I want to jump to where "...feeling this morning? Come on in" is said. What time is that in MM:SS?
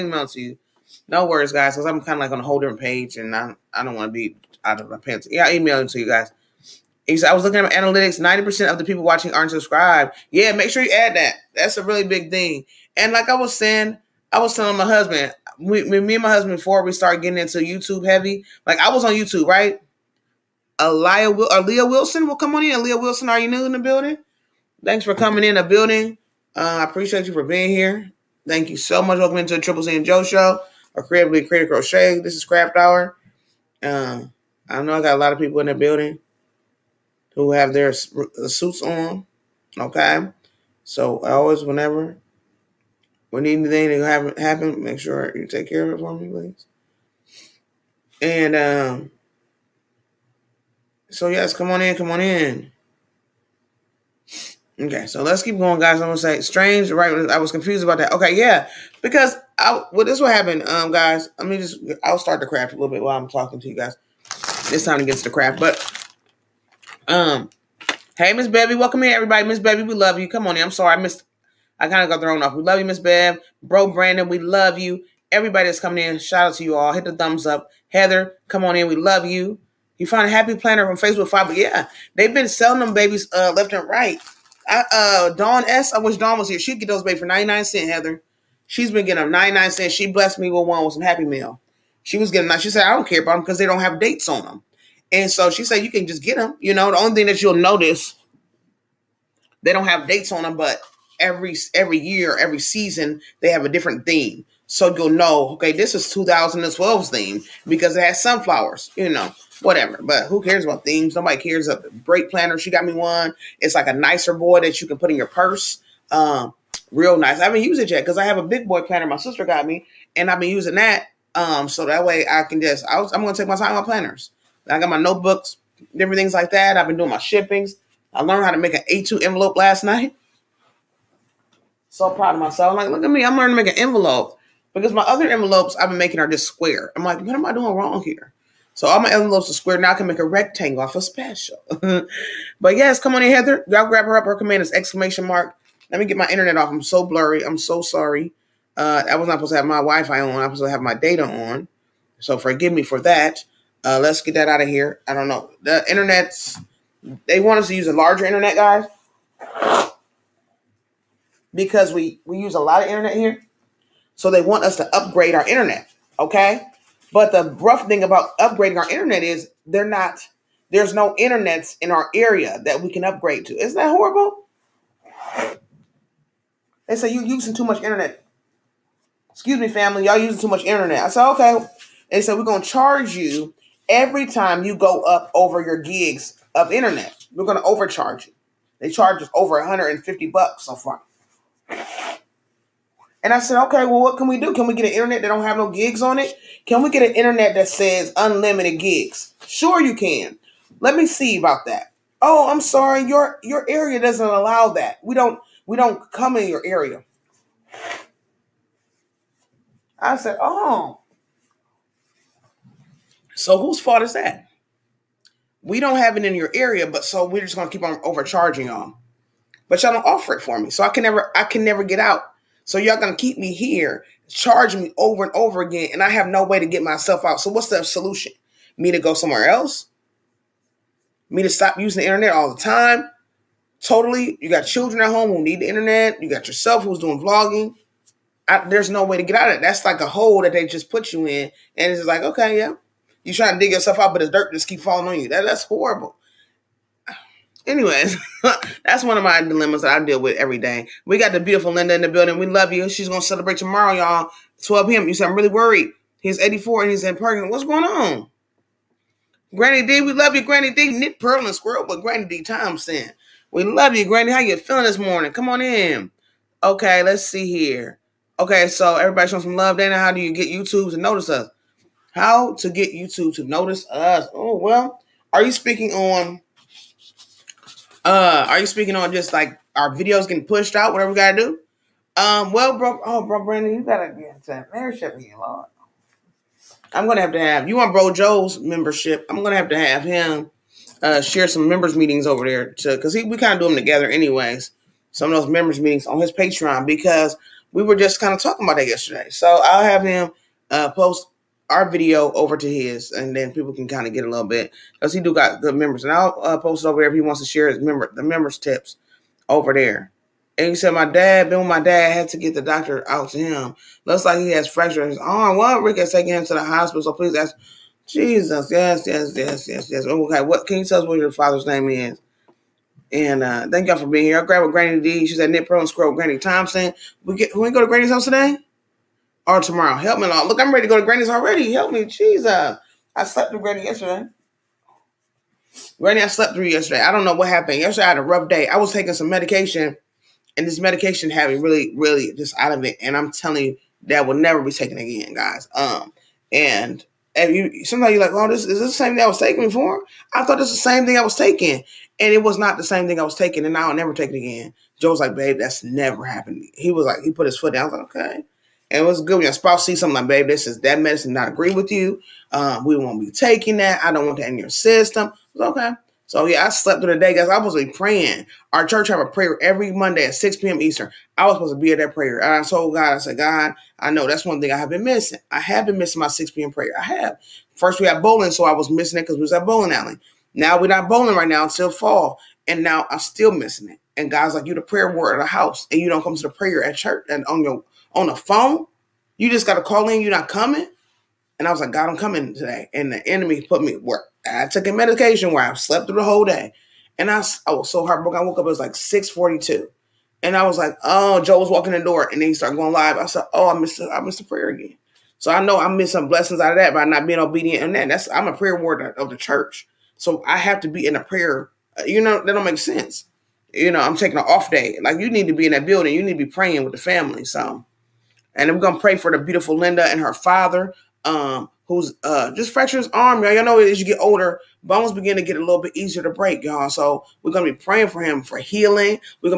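04:24.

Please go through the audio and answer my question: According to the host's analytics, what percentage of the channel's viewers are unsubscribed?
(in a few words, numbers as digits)
90%.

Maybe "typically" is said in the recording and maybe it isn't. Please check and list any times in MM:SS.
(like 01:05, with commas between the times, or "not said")
not said.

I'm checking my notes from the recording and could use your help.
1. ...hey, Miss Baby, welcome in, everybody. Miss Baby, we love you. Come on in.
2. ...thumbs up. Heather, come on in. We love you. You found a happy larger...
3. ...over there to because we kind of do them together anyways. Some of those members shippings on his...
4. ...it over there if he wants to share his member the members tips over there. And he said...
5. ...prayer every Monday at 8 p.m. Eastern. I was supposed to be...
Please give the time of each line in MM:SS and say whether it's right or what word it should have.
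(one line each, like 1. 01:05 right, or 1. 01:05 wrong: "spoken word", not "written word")
1. 01:08 right
2. 01:17 wrong: "planner", not "larger"
3. 04:52 wrong: "meetings", not "shippings"
4. 05:06 right
5. 06:09 wrong: "6", not "8".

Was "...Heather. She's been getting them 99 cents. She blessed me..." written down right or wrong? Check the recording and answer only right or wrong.
right.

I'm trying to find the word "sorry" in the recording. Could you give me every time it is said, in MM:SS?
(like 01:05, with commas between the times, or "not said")
01:10, 02:27, 03:22.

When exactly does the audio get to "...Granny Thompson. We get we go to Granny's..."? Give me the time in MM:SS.
05:26.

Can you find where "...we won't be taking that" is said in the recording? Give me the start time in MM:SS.
06:02.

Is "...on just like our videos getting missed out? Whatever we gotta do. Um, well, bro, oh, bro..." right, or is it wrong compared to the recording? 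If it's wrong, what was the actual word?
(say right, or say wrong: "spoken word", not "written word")
wrong: "pushed", not "missed".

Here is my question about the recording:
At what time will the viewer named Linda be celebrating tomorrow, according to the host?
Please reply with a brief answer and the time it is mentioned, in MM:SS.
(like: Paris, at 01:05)
12 p.m., at 04:14.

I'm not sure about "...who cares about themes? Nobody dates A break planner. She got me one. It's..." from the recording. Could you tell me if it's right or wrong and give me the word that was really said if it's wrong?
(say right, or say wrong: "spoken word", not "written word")
wrong: "cares", not "dates".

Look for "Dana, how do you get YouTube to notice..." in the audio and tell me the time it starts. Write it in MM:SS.
04:29.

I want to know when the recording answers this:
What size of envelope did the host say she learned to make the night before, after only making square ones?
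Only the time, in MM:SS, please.
02:08.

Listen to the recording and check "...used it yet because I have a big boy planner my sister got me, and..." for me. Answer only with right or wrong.
right.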